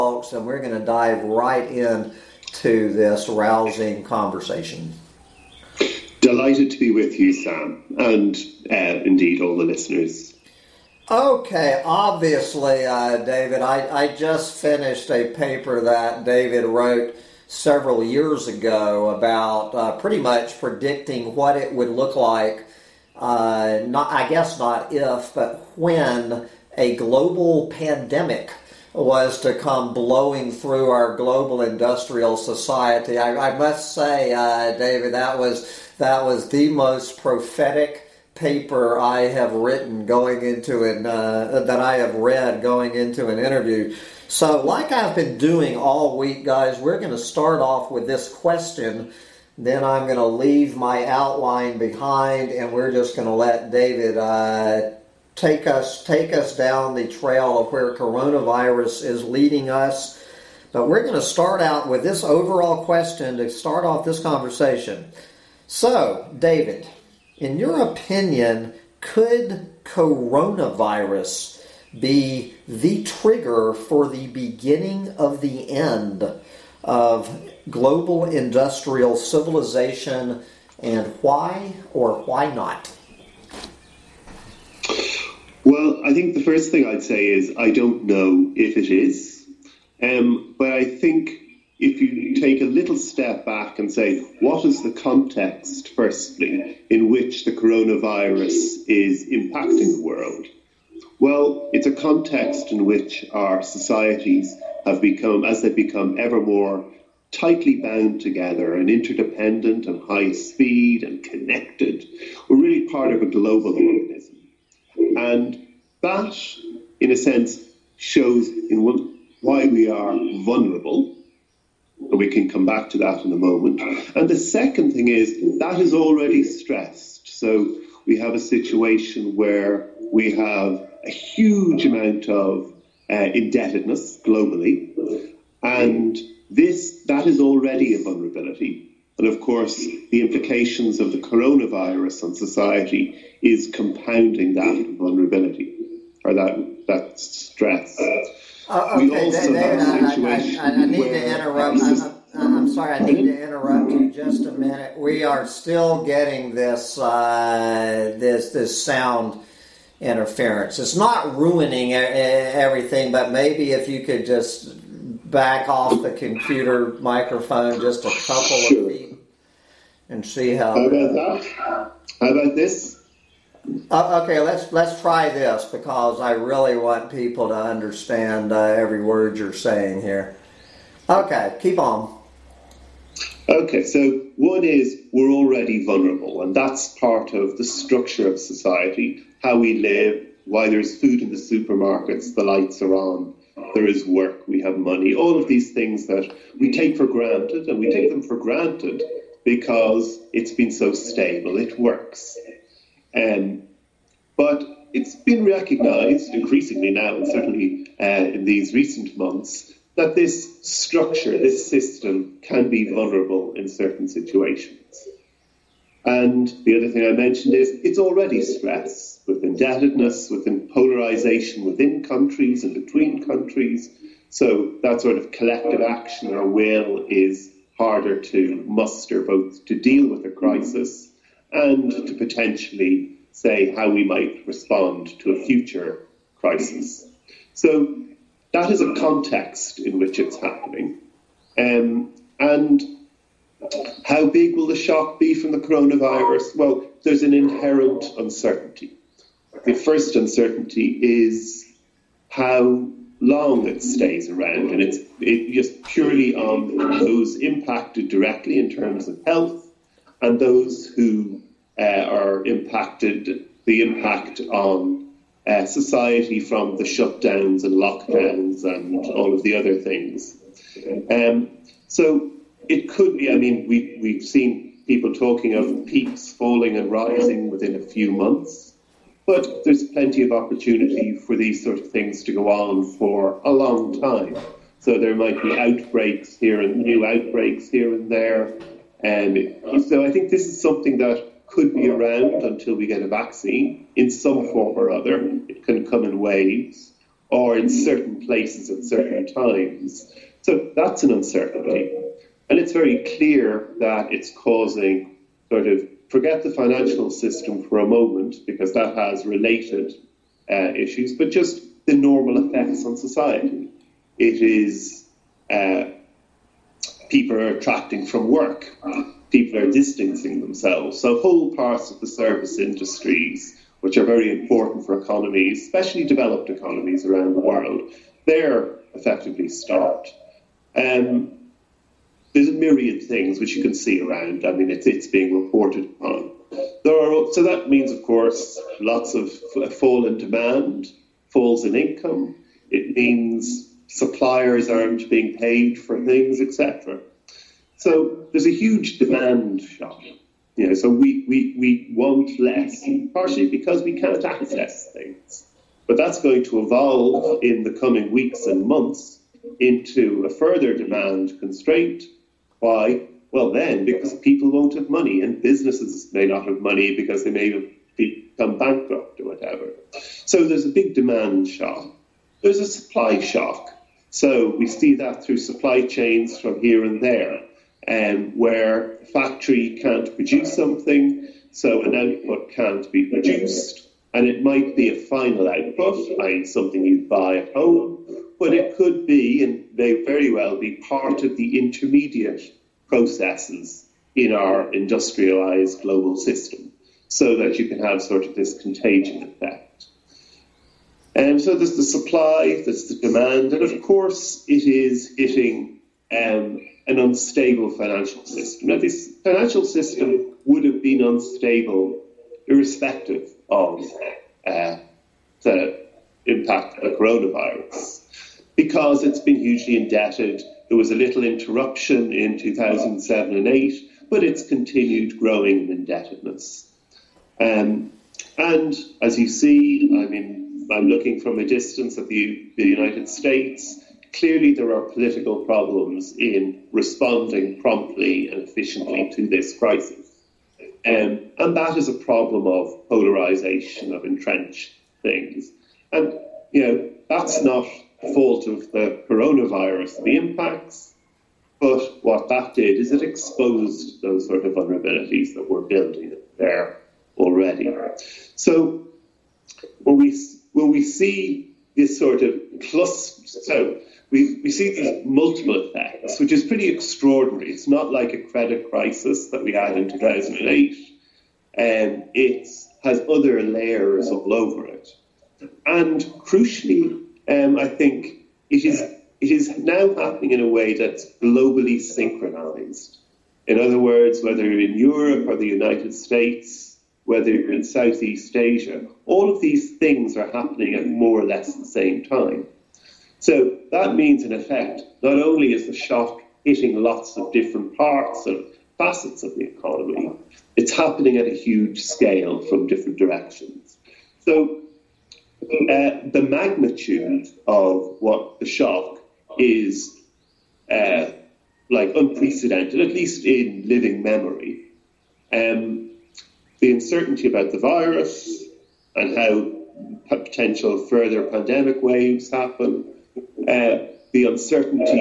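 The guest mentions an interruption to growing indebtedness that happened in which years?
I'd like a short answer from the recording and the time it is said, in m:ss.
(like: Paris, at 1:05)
2007 and 2008, at 7:02.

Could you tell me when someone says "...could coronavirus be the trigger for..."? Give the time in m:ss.
1:08.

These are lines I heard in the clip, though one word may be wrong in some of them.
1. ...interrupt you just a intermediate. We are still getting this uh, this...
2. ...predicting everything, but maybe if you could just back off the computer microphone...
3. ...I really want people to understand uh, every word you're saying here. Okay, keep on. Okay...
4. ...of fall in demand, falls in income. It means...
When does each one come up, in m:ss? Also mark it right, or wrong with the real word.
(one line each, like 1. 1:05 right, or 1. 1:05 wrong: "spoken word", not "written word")
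1. 2:33 wrong: "minute", not "intermediate"
2. 2:41 wrong: "ruining", not "predicting"
3. 2:56 right
4. 5:39 right.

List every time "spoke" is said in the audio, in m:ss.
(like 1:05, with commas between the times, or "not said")
not said.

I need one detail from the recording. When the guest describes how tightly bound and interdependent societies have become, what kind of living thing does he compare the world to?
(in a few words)
a global organism.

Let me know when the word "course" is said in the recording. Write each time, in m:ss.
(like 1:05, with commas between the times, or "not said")
2:19, 5:38, 6:43.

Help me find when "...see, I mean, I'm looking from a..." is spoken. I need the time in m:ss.
7:09.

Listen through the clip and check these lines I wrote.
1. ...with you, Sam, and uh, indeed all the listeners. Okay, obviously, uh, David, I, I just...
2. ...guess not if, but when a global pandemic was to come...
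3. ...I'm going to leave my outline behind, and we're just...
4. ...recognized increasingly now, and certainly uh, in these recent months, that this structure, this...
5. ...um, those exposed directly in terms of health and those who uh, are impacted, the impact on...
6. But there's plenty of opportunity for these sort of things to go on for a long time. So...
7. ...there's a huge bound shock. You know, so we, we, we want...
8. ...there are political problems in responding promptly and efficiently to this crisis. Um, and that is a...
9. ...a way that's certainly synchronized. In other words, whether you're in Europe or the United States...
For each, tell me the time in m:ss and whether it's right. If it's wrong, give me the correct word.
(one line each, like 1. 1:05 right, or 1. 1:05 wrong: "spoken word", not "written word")
1. 0:06 right
2. 0:24 right
3. 0:49 right
4. 3:25 right
5. 4:16 wrong: "impacted", not "exposed"
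6. 4:39 right
7. 5:48 wrong: "demand", not "bound"
8. 7:14 right
9. 8:00 wrong: "globally", not "certainly".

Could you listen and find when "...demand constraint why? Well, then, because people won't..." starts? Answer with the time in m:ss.
6:00.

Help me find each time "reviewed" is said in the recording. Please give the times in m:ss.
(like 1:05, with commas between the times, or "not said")
not said.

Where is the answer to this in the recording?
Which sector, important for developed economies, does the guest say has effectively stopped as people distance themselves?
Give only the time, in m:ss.
5:22.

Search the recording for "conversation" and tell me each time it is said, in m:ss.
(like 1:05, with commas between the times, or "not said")
0:04, 1:04.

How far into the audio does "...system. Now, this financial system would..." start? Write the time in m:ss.
6:48.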